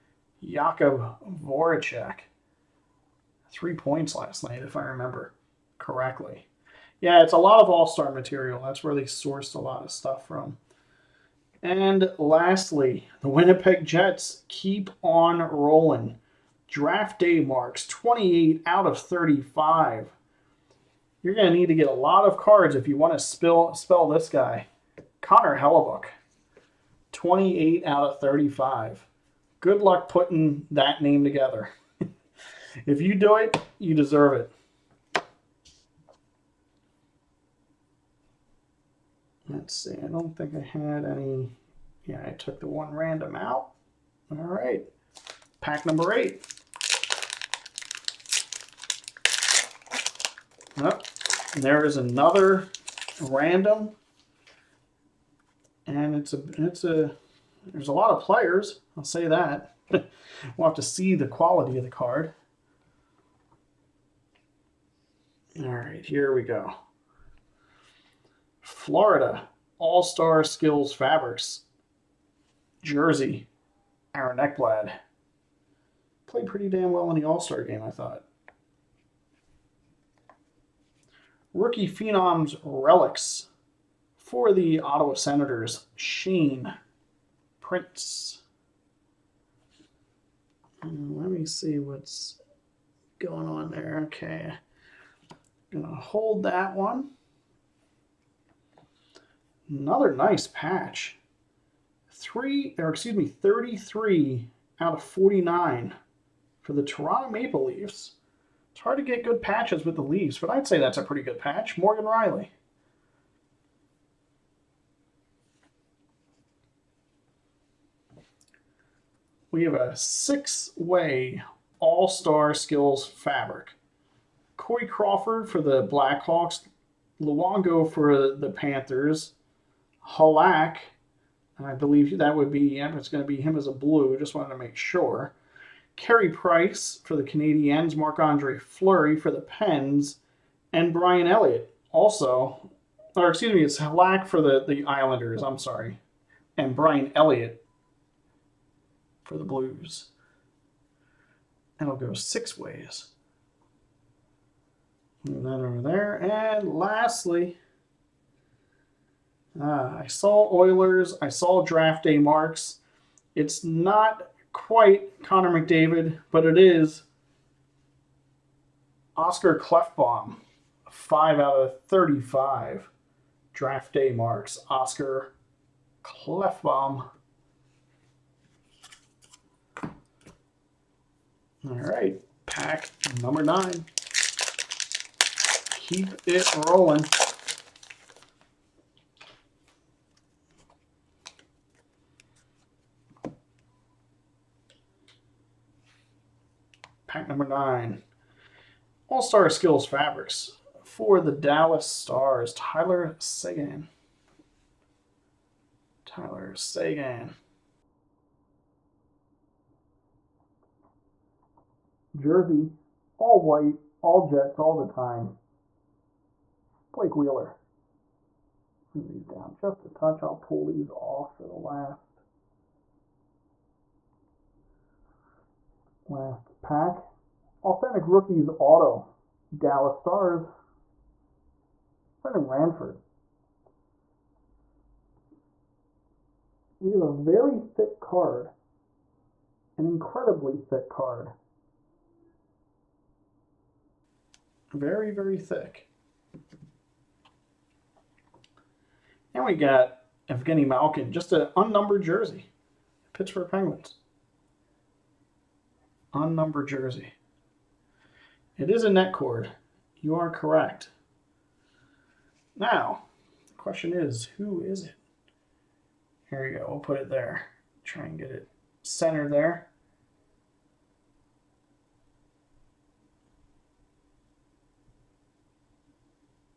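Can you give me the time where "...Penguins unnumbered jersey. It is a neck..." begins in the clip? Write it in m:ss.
4:13.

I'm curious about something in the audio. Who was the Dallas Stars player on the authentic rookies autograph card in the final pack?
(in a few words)
Brendan Ranford.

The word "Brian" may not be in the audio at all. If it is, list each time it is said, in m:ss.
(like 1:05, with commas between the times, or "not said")
2:20, 2:26.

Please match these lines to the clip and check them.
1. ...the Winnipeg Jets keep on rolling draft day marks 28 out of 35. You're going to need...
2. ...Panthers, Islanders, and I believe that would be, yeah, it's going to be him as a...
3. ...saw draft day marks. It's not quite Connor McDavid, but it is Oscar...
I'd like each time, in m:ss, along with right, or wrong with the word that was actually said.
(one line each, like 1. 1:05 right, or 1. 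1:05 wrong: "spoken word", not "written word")
1. 0:13 right
2. 2:08 wrong: "Halak", not "Islanders"
3. 2:41 right.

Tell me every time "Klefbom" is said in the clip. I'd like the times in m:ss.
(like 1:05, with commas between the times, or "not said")
2:49, 2:56.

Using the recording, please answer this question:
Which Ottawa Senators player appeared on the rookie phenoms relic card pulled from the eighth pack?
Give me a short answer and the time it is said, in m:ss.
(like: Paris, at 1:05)
Shane Prince, at 1:25.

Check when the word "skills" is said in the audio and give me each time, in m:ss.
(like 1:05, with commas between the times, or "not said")
1:10, 2:02, 3:19.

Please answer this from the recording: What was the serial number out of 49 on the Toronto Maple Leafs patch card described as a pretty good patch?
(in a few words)
33.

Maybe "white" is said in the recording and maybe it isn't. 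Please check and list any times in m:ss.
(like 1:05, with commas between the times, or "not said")
3:33.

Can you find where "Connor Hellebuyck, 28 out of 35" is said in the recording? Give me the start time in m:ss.
0:25.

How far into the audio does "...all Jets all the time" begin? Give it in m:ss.
3:34.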